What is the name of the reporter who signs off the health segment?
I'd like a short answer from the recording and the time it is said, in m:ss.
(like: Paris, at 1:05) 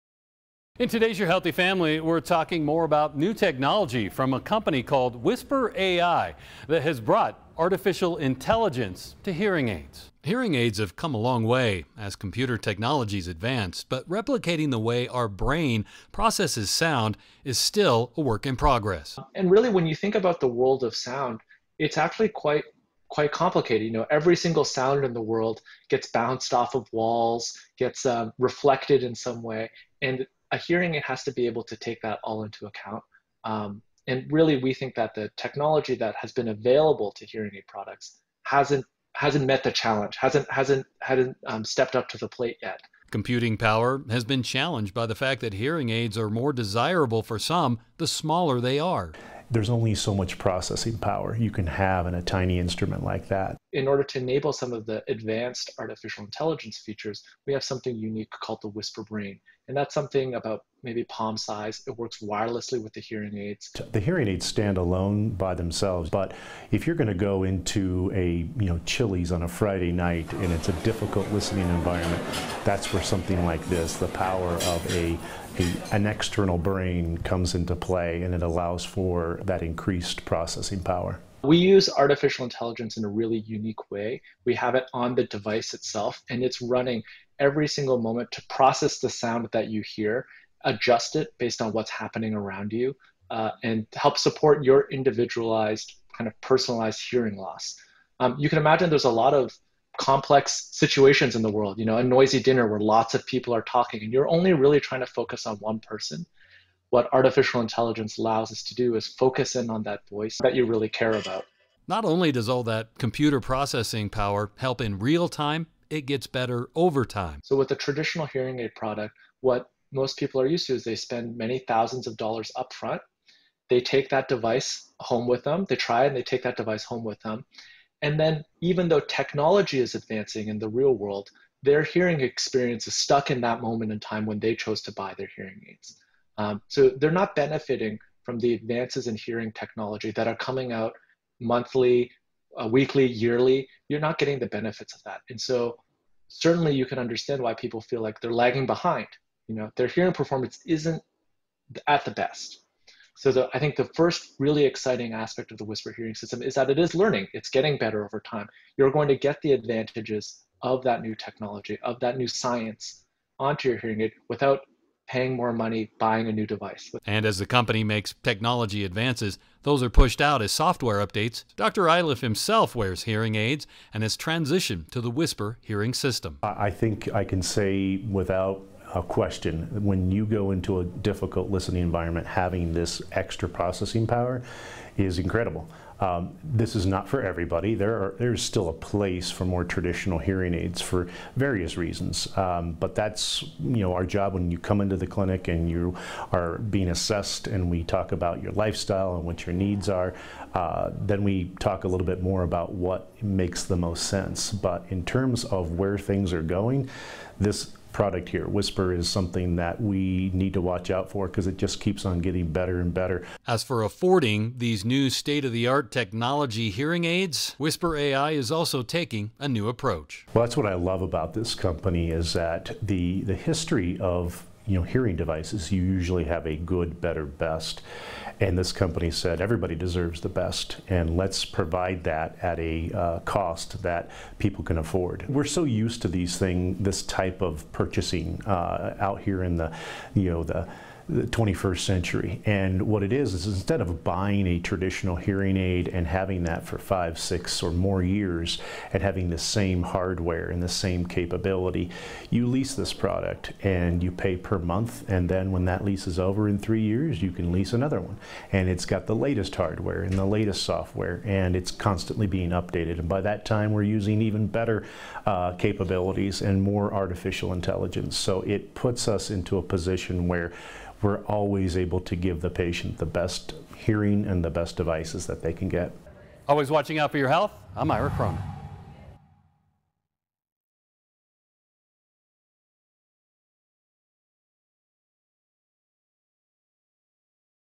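Ira Cronin, at 4:37.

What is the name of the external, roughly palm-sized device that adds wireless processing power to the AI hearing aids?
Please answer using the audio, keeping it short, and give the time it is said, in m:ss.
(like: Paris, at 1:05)
Whisper Brain, at 0:58.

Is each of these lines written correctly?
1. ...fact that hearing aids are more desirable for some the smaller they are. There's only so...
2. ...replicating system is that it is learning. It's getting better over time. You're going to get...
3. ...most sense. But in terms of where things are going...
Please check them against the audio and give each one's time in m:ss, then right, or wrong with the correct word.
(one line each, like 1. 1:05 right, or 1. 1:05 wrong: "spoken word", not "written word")
1. 0:45 right
2. 2:35 wrong: "hearing", not "replicating"
3. 3:23 right.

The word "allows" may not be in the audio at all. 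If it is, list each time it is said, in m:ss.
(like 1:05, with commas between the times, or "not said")
1:18, 1:48.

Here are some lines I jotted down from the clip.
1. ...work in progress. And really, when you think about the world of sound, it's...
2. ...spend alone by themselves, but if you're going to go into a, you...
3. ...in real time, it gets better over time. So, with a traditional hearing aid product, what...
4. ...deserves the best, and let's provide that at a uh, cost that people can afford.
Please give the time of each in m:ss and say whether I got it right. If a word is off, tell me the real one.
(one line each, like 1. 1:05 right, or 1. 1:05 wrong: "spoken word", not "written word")
1. 0:18 right
2. 1:04 wrong: "stand", not "spend"
3. 1:54 right
4. 3:49 right.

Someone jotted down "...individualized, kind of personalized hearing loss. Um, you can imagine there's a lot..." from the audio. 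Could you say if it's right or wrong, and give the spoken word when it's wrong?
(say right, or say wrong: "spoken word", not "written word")
right.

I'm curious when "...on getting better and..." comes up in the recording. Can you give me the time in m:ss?
3:32.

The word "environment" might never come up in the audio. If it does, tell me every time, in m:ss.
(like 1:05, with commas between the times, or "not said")
1:11, 3:01.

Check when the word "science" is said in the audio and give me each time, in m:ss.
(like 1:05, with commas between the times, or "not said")
2:42.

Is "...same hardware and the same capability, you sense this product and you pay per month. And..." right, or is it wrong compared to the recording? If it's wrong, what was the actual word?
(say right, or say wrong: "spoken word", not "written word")
wrong: "lease", not "sense".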